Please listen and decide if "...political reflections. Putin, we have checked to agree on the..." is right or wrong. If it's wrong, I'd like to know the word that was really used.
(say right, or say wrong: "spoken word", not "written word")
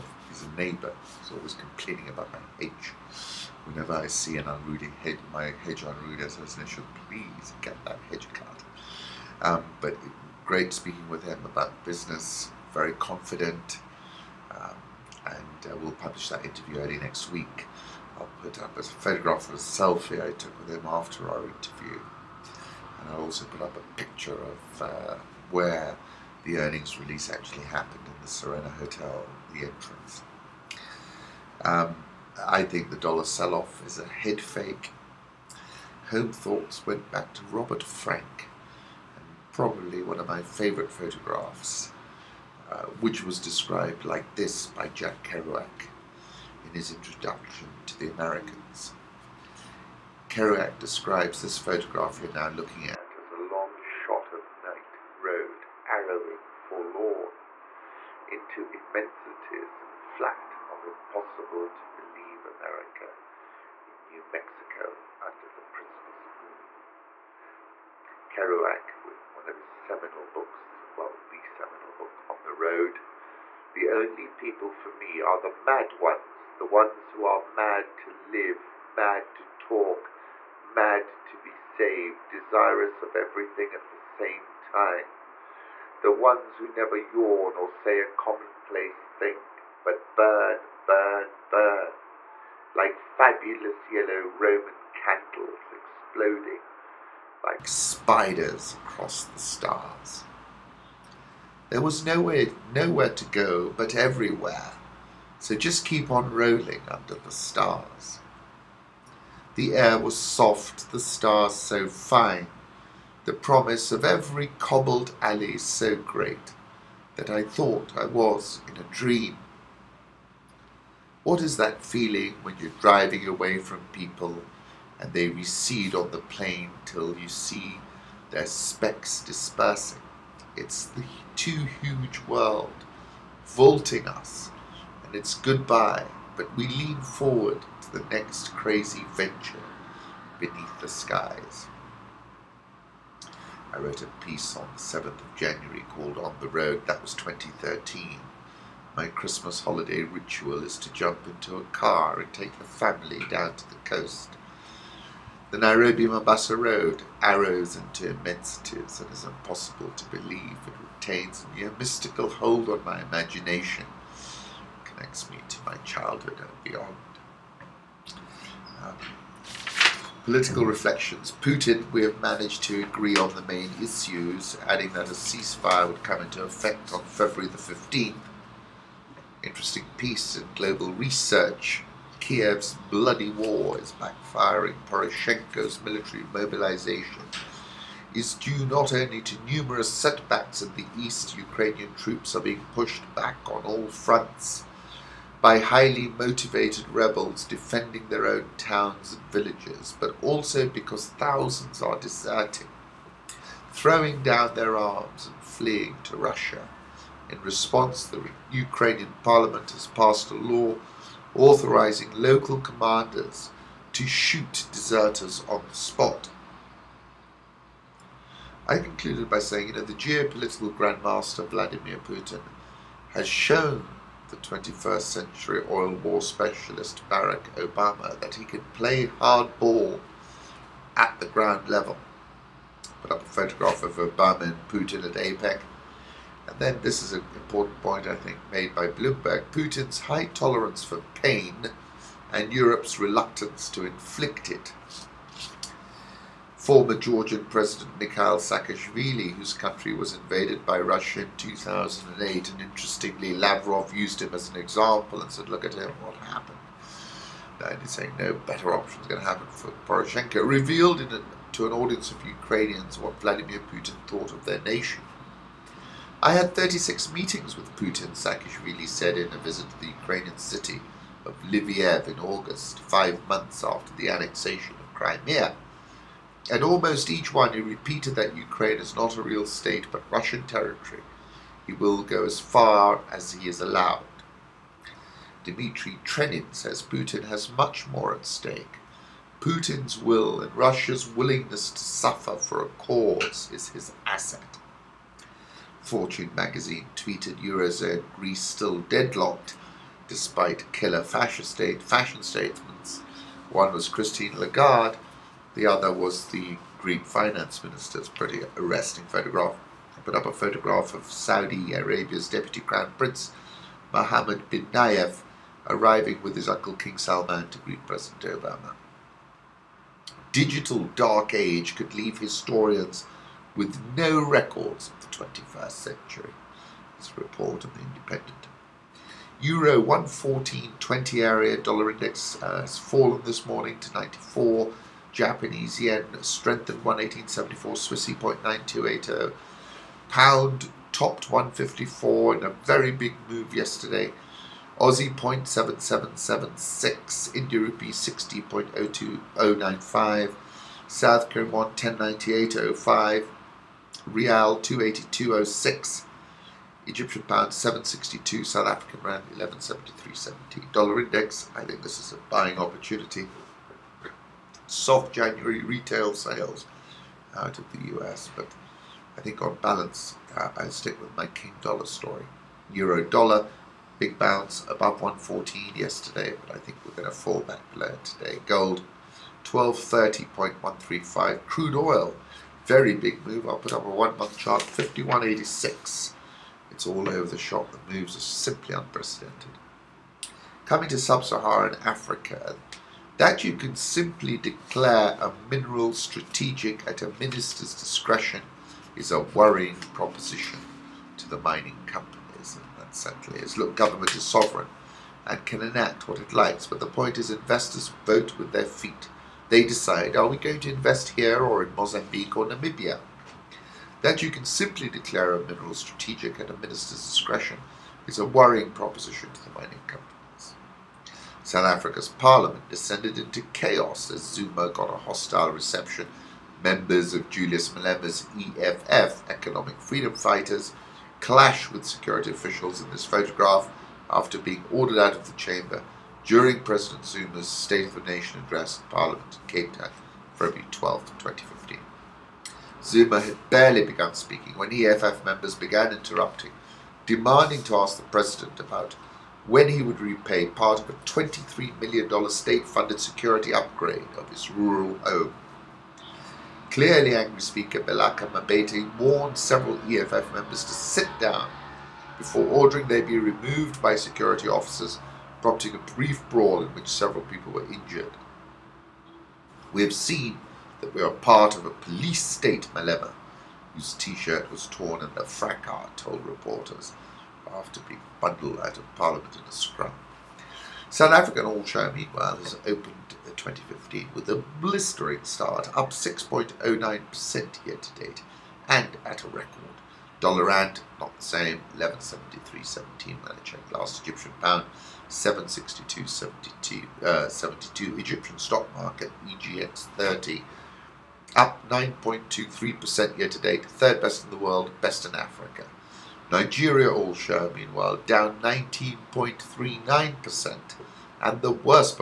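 wrong: "managed", not "checked".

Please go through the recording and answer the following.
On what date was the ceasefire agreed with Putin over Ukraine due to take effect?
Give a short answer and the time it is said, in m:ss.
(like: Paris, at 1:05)
February 15th, at 2:57.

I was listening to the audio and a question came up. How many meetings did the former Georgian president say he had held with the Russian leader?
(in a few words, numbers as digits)
36.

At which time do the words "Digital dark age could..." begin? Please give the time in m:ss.
5:20.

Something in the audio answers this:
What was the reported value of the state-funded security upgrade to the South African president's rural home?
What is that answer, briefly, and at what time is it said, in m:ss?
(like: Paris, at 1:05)
$23 million, at 7:30.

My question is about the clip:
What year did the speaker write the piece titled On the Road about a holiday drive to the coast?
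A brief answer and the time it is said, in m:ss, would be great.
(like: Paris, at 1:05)
2013, at 2:27.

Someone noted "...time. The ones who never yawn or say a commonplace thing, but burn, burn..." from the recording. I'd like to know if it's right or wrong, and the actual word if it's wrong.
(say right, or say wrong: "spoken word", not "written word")
right.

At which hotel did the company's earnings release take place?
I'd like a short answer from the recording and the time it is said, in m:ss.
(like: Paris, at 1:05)
Serena Hotel, at 0:28.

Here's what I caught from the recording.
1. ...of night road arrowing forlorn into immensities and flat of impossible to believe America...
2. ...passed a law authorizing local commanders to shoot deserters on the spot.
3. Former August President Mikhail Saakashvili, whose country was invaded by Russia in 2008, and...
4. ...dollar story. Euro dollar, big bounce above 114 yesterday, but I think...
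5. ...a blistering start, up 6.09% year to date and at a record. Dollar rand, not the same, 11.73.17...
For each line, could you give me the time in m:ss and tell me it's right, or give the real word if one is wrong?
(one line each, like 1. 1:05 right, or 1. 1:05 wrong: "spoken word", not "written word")
1. 0:54 right
2. 3:29 right
3. 4:06 wrong: "Georgian", not "August"
4. 6:11 right
5. 8:04 right.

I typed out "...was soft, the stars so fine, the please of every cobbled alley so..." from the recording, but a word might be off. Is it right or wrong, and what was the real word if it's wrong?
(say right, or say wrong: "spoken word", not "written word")
wrong: "promise", not "please".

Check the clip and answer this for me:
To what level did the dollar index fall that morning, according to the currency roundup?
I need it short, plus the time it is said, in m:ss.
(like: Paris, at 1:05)
94, at 5:33.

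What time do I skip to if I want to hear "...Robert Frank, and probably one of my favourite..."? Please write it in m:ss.
0:37.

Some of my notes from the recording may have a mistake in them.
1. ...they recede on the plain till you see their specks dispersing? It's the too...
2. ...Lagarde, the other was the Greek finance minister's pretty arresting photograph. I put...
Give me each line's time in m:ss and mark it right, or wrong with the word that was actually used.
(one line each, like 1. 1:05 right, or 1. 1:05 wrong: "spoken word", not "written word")
1. 2:05 right
2. 5:04 right.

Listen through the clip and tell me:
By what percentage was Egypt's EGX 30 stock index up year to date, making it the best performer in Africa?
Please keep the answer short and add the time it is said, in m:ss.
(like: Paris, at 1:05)
9.23%, at 8:21.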